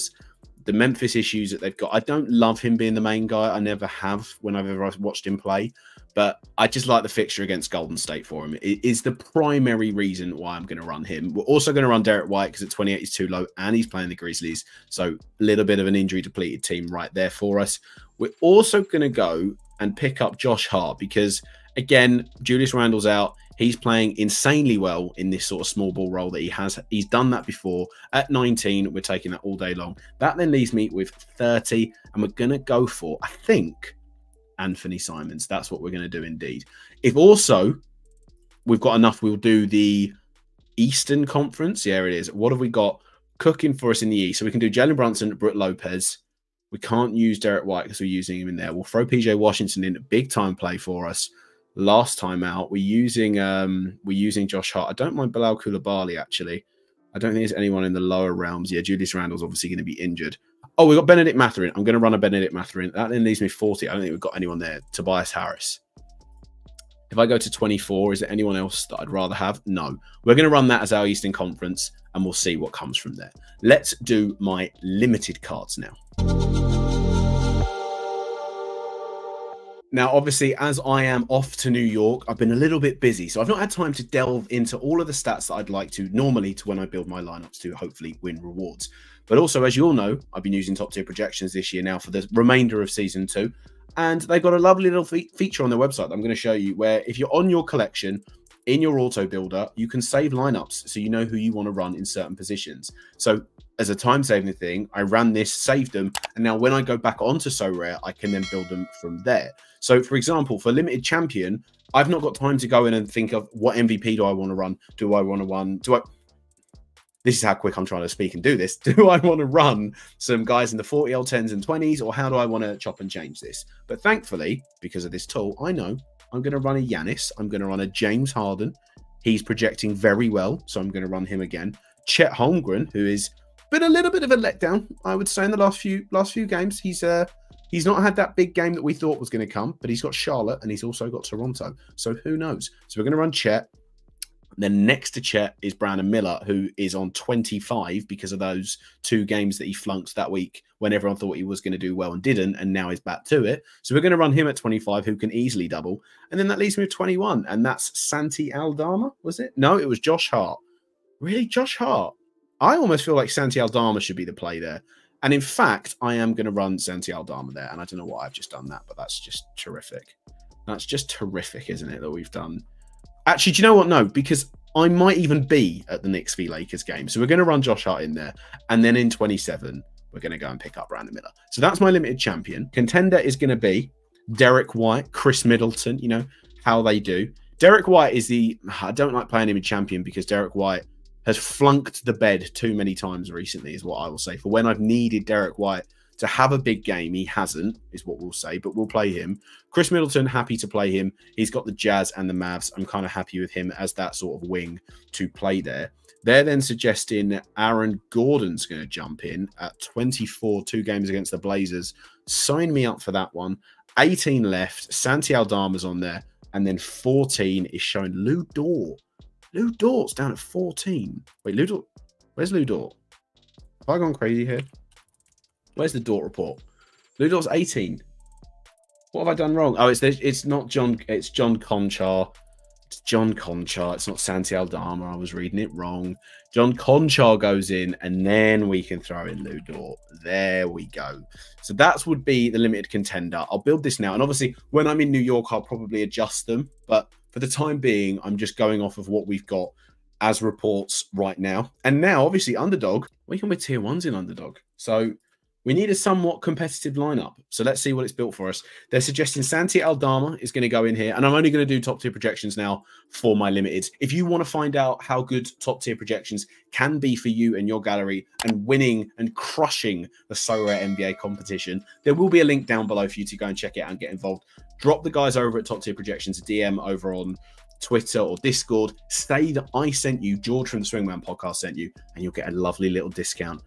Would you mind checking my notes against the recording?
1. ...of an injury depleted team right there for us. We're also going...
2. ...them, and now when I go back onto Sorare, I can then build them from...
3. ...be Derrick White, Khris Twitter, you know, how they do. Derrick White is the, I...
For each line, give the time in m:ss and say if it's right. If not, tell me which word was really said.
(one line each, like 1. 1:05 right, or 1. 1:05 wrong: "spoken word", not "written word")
1. 0:15 right
2. 1:45 right
3. 3:03 wrong: "Middleton", not "Twitter".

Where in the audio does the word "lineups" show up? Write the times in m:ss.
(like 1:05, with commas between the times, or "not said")
1:27, 1:40, 4:16.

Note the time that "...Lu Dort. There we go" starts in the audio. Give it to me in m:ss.
3:59.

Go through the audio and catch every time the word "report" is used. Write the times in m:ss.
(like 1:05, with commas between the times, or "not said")
3:46, 4:10.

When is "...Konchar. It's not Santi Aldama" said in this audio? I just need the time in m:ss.
3:53.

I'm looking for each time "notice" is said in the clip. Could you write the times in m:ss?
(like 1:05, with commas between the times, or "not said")
not said.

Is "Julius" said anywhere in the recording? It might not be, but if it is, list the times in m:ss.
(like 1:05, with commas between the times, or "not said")
0:22, 0:58.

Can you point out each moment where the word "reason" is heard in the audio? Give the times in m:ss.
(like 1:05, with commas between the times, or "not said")
0:09.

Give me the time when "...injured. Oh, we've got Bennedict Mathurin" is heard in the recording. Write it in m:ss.
1:00.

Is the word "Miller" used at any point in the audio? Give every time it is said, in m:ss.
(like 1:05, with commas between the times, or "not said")
2:26, 3:01.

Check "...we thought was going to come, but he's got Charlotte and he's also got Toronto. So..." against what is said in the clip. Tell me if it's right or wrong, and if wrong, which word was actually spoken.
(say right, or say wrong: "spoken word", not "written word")
right.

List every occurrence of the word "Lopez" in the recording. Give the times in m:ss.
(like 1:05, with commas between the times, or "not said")
0:45.